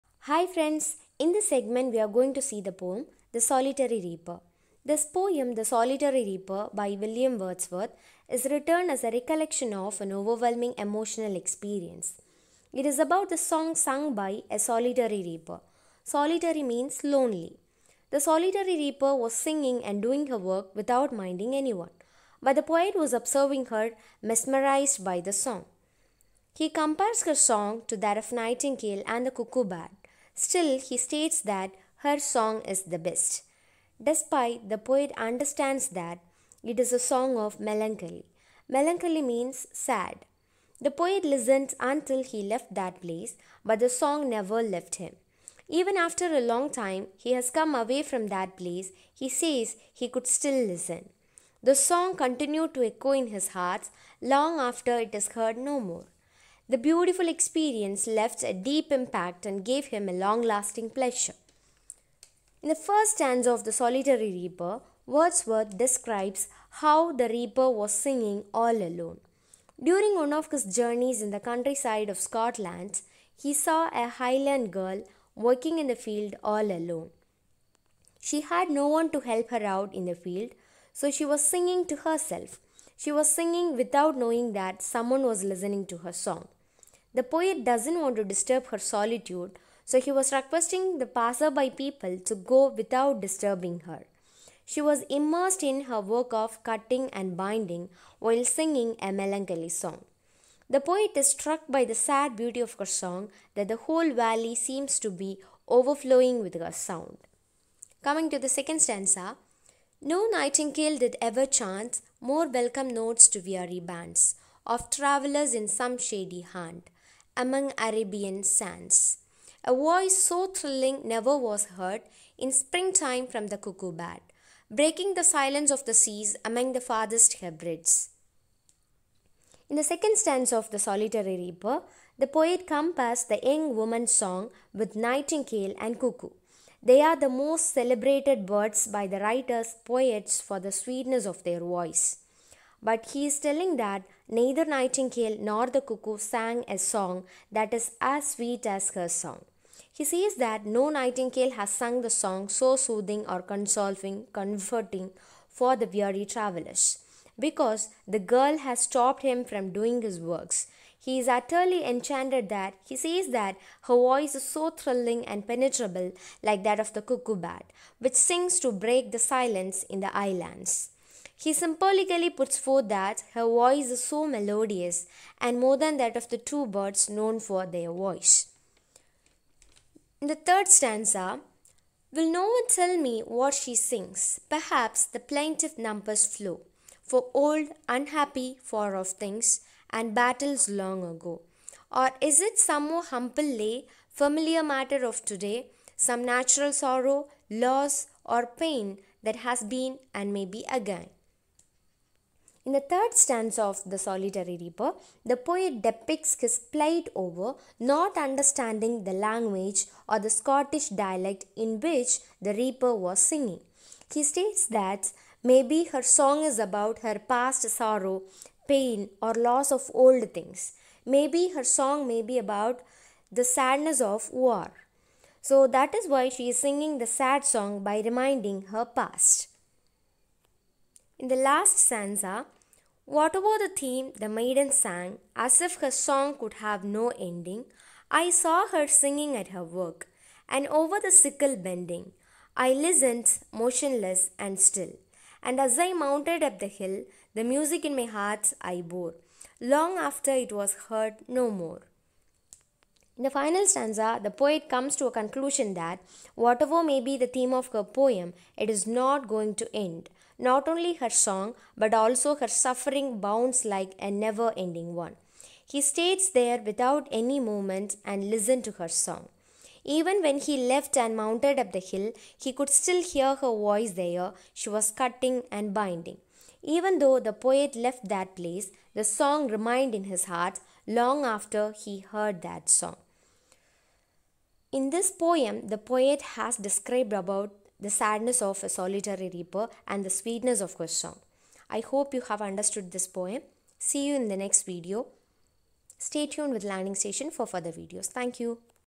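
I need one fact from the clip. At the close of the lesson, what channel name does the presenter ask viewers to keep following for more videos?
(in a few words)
Learning Station.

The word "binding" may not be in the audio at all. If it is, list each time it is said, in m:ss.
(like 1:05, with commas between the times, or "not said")
1:37, 4:35.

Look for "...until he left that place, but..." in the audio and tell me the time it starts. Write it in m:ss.
0:41.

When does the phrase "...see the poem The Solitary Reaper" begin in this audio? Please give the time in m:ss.
0:02.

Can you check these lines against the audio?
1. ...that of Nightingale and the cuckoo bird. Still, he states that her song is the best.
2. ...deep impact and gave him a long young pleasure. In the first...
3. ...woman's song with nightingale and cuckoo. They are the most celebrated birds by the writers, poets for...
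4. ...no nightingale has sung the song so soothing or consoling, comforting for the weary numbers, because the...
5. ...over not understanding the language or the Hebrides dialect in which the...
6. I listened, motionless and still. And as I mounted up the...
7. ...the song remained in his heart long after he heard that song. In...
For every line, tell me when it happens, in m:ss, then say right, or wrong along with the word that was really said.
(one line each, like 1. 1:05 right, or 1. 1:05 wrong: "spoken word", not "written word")
1. 0:27 right
2. 0:58 wrong: "lasting", not "young"
3. 2:13 right
4. 2:30 wrong: "travelers", not "numbers"
5. 3:27 wrong: "Scottish", not "Hebrides"
6. 4:02 right
7. 4:38 right.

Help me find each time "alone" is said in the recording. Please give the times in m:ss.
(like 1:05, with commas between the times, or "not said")
1:08, 1:16.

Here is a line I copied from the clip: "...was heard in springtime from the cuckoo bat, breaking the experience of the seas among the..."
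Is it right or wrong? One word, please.
wrong.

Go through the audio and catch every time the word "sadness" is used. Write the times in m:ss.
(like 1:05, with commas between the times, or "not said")
3:43, 4:47.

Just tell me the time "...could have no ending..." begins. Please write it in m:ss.
3:56.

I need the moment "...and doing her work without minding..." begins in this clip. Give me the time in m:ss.
0:19.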